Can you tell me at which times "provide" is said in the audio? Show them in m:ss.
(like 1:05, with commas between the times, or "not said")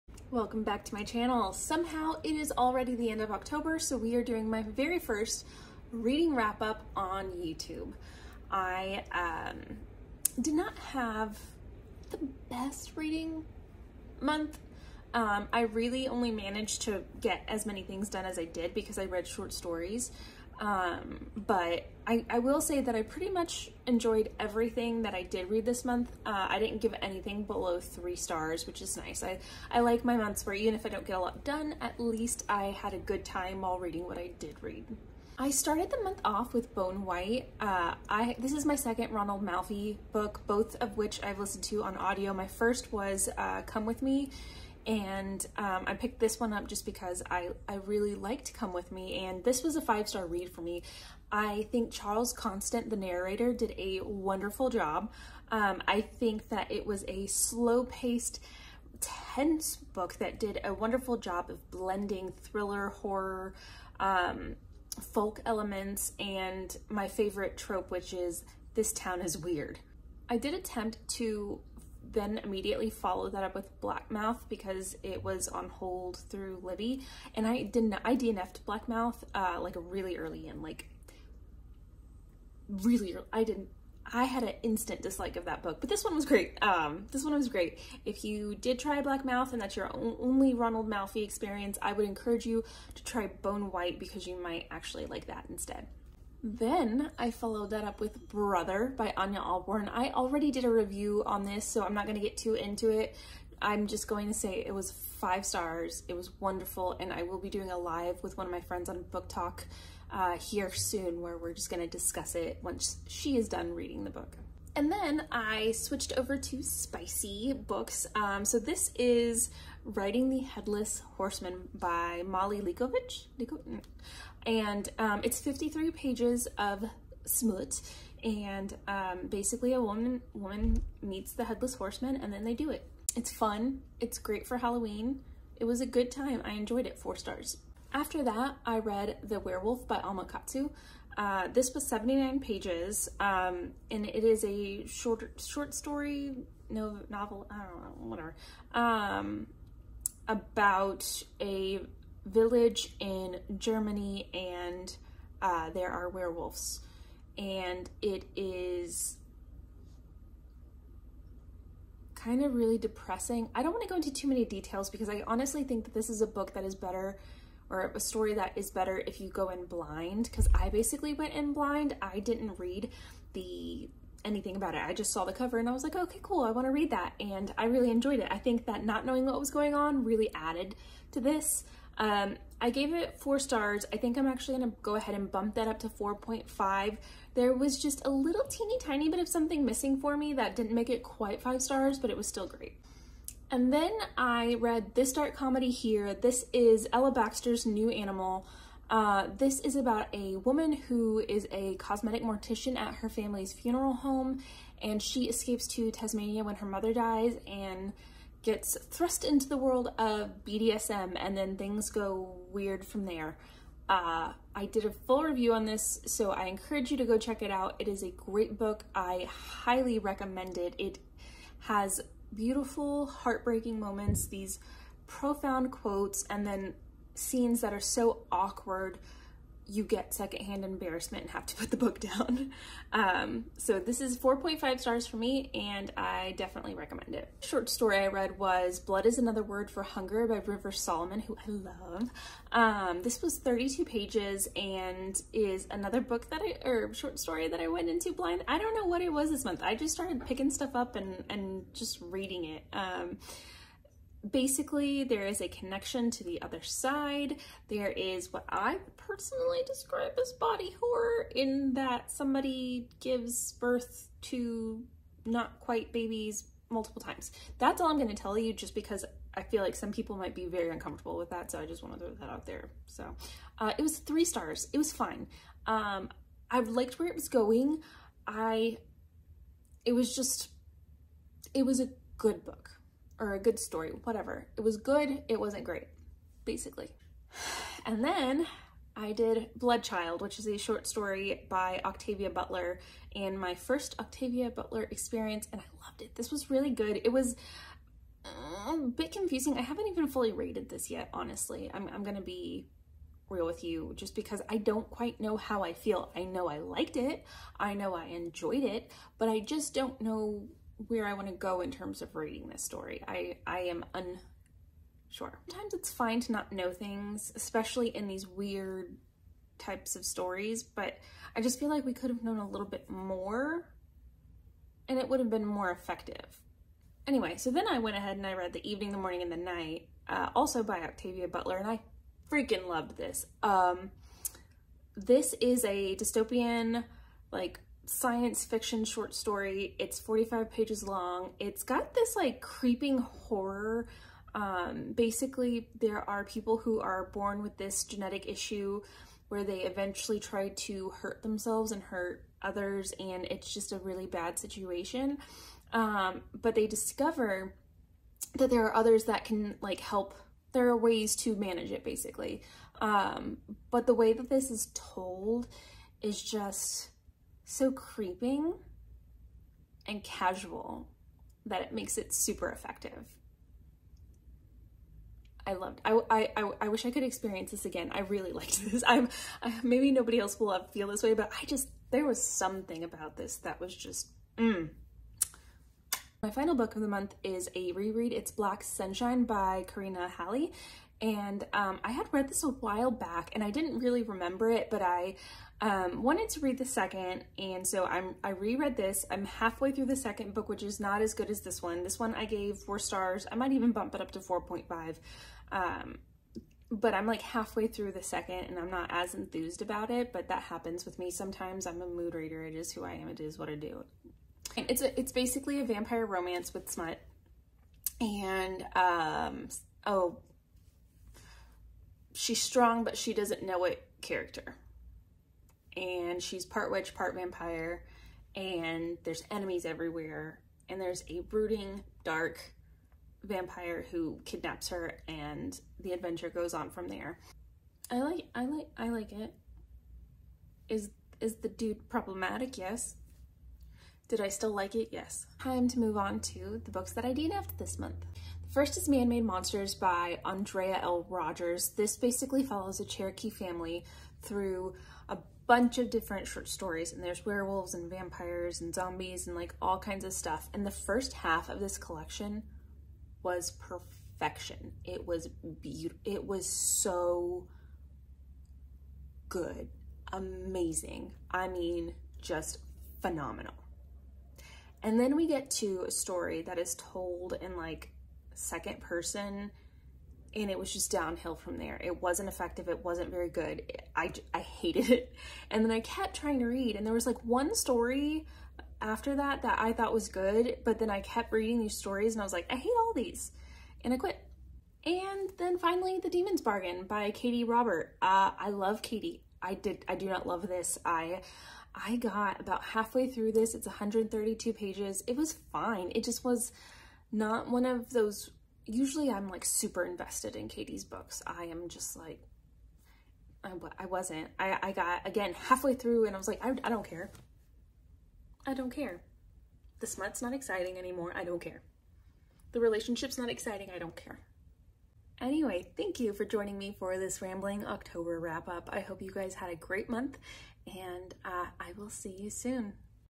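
not said.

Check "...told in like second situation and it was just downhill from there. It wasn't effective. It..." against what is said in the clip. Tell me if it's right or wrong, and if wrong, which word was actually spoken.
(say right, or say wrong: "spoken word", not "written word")
wrong: "person", not "situation".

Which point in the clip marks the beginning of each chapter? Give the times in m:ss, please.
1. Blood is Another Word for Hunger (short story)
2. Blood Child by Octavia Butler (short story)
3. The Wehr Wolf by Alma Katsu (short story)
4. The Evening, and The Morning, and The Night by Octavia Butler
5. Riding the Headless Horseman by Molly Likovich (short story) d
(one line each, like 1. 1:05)
1. 3:57
2. 4:48
3. 2:19
4. 5:28
5. 1:56.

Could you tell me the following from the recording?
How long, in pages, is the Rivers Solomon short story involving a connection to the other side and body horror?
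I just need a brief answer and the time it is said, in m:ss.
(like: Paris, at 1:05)
32, at 4:03.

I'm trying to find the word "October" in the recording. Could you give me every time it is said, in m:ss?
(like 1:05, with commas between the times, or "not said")
0:03, 8:47.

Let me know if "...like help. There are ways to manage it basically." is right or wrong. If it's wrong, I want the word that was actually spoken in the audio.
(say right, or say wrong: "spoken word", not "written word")
right.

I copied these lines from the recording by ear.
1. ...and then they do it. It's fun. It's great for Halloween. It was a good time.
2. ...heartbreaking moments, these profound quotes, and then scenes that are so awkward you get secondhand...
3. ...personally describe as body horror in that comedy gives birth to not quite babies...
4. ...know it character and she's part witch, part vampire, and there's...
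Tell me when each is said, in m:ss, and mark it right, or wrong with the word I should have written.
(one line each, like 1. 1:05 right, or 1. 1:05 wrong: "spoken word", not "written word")
1. 2:12 right
2. 3:43 right
3. 4:18 wrong: "somebody", not "comedy"
4. 7:03 right.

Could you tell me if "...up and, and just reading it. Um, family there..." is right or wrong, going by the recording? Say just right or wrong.
wrong.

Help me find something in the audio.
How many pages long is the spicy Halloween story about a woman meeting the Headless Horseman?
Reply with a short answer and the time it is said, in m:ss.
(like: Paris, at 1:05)
53, at 2:05.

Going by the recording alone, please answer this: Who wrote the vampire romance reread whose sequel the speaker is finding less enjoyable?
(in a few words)
Karina Halle.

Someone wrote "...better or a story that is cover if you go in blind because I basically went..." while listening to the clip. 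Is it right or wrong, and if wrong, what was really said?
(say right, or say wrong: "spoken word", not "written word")
wrong: "better", not "cover".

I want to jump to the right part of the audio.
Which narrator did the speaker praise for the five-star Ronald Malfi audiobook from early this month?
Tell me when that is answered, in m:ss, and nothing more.
0:51.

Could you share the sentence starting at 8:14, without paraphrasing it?
And then finally The Demon's Bargain by Katee Robert.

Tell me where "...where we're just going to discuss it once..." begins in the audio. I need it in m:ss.
1:51.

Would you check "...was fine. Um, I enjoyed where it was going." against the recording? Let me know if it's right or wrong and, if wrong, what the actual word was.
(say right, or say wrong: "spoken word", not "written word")
wrong: "liked", not "enjoyed".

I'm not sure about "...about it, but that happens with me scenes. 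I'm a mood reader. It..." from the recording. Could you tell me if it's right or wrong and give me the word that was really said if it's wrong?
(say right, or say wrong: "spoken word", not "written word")
wrong: "sometimes", not "scenes".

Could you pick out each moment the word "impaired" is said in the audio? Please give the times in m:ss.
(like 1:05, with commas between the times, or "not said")
not said.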